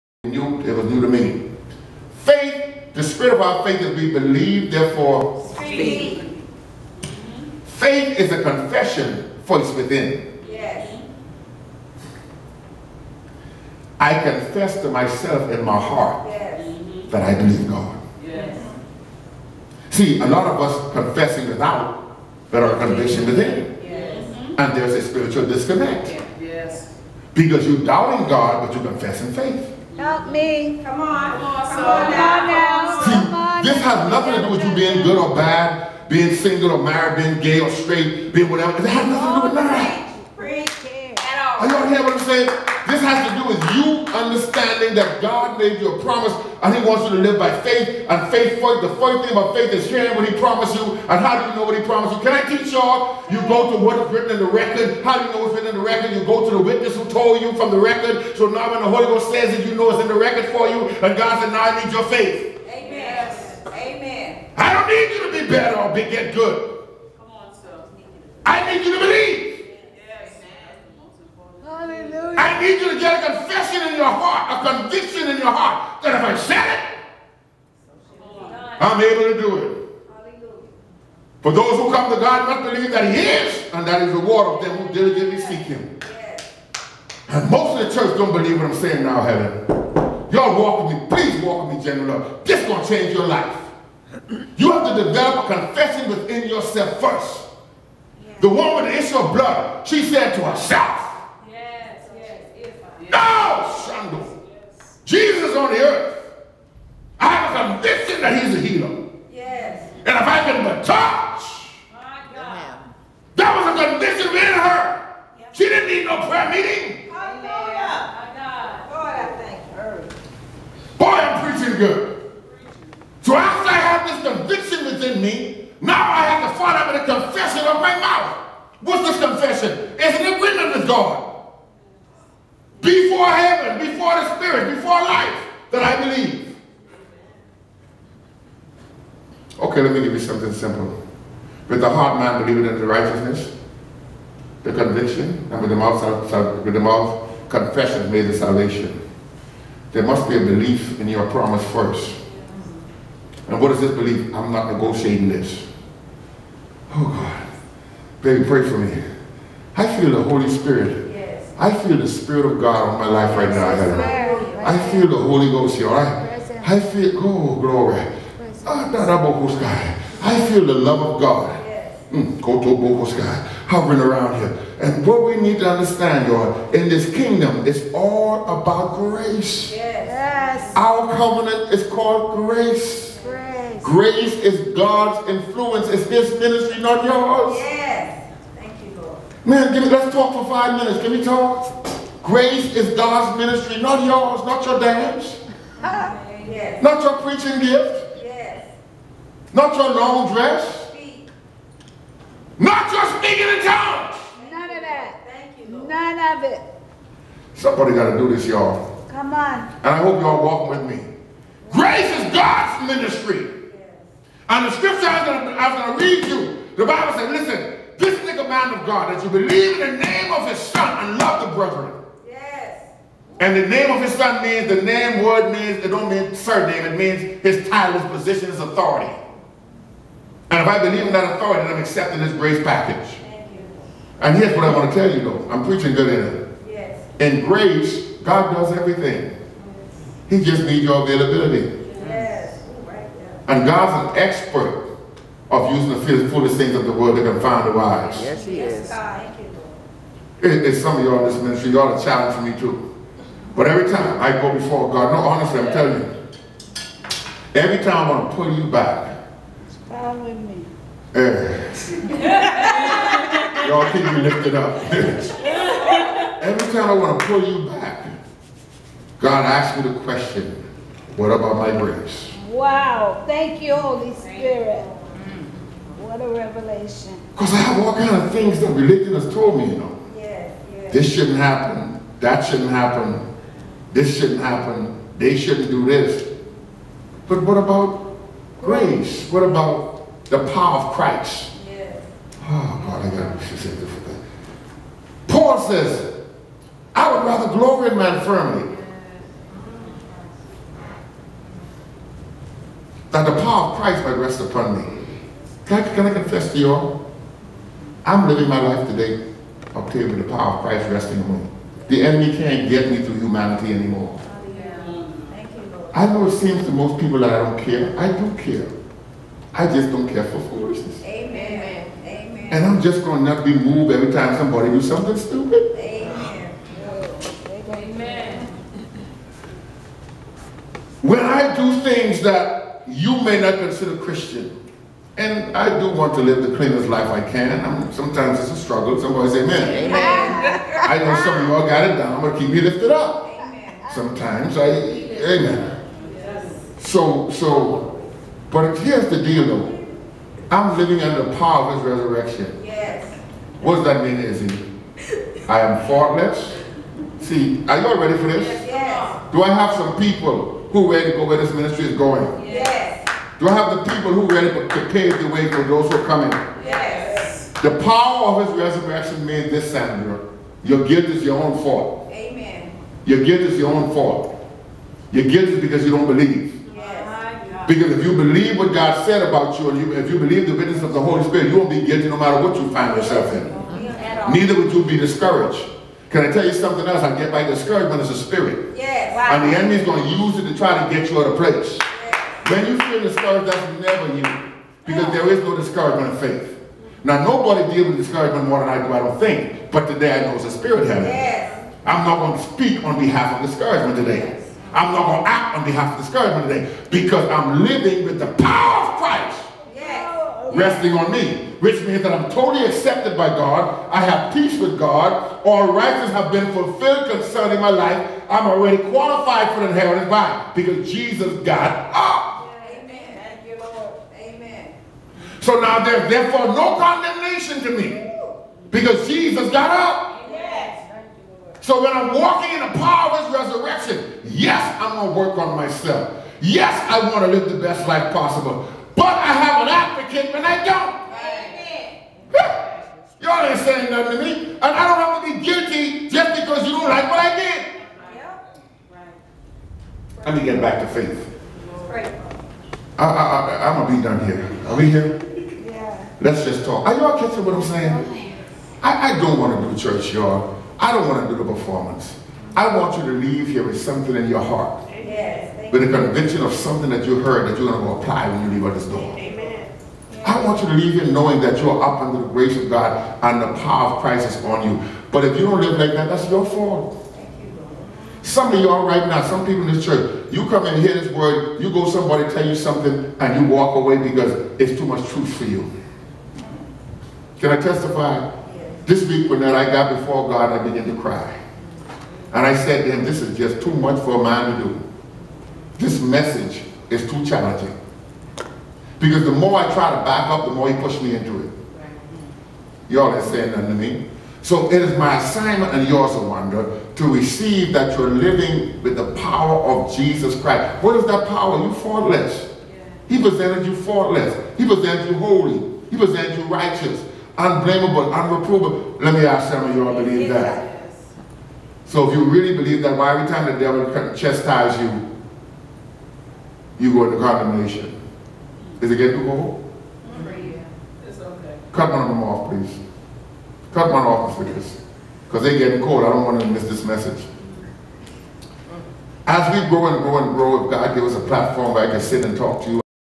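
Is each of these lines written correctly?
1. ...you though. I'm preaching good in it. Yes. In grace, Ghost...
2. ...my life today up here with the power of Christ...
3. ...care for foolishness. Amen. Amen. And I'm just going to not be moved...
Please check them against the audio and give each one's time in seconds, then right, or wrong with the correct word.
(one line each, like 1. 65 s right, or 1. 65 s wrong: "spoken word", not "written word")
1. 235 s wrong: "God", not "Ghost"
2. 308 s right
3. 320 s right.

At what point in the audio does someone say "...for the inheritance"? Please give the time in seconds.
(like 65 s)
419 s.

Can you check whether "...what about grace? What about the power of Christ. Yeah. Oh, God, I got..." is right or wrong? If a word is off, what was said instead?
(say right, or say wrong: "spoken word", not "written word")
right.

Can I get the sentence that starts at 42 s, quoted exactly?
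This has to do with you understanding that God made you a promise and he wants you to live by faith.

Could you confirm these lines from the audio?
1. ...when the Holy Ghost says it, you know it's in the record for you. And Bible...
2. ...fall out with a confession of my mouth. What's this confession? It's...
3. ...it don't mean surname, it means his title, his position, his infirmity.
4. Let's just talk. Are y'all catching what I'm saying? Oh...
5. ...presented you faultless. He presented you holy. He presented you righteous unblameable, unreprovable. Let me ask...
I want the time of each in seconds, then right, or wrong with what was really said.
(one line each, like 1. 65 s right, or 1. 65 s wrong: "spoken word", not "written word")
1. 58 s wrong: "God", not "Bible"
2. 126 s right
3. 225 s wrong: "authority", not "infirmity"
4. 456 s right
5. 513 s right.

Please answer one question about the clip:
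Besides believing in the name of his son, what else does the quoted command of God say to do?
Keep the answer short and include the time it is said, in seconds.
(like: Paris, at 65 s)
Love the brethren, at 221 s.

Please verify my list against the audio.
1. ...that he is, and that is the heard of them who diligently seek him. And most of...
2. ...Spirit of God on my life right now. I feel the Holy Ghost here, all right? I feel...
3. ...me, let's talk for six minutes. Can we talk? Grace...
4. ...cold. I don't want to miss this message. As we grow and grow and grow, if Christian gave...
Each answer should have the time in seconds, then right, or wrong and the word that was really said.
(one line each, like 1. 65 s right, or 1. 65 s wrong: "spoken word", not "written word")
1. 82 s wrong: "reward", not "heard"
2. 162 s right
3. 189 s wrong: "five", not "six"
4. 535 s wrong: "God", not "Christian".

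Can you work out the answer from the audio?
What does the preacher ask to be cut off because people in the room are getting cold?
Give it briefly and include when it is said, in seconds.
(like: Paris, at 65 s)
One of them, at 531 s.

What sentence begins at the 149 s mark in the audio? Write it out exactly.
There must be a belief in your promise first.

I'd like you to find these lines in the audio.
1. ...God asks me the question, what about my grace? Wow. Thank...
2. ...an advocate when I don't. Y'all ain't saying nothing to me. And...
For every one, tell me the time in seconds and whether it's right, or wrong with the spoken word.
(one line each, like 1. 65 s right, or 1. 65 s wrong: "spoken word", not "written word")
1. 269 s right
2. 439 s right.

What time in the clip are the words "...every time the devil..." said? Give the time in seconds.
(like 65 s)
523 s.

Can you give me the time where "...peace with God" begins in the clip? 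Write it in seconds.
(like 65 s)
414 s.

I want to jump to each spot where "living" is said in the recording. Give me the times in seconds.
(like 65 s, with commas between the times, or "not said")
308 s, 350 s, 407 s, 508 s.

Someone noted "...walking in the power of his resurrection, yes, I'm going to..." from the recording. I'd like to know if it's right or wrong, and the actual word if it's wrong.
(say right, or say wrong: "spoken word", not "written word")
right.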